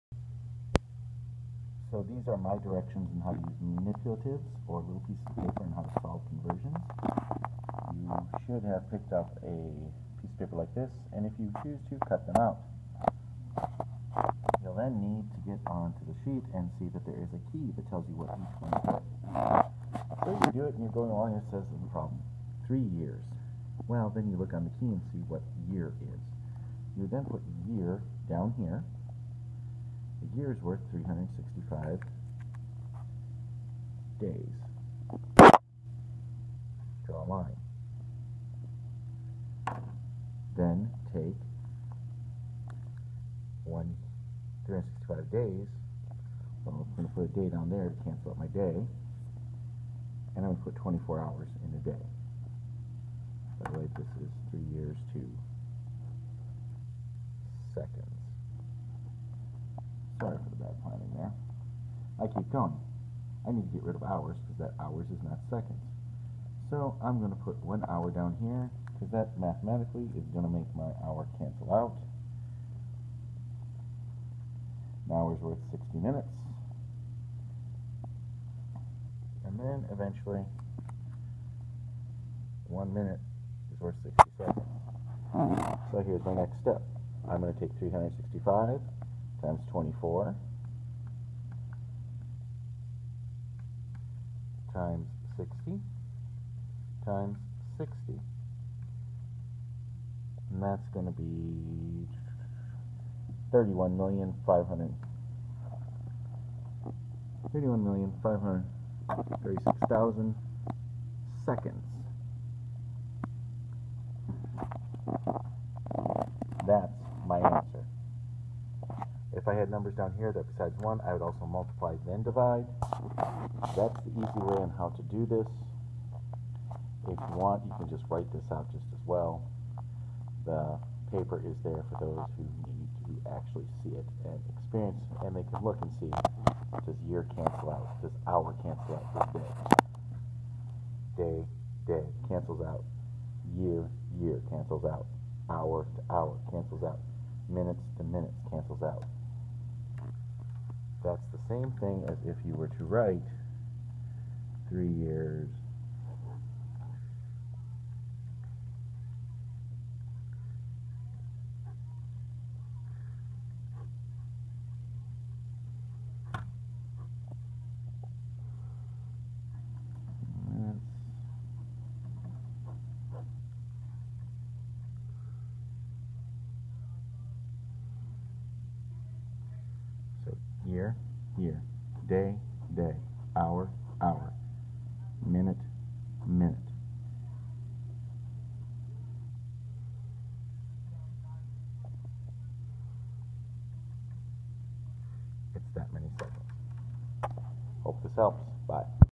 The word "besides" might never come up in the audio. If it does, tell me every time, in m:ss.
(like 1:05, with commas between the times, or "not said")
2:00.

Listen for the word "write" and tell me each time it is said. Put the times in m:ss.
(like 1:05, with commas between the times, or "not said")
2:08, 2:32.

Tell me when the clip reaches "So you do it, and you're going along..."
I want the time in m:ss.
0:20.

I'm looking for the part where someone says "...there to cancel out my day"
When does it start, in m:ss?
0:47.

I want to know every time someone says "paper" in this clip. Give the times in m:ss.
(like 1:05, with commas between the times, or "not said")
0:05, 0:10, 2:11.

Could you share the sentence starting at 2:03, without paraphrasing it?
That's the easy way on how to do this.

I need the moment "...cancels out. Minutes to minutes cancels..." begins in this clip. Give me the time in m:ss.
2:26.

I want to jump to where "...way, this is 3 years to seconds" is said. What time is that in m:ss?
0:53.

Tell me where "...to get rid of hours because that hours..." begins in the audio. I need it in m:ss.
1:03.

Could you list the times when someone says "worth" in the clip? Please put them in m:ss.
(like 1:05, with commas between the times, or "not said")
0:30, 1:15, 1:23.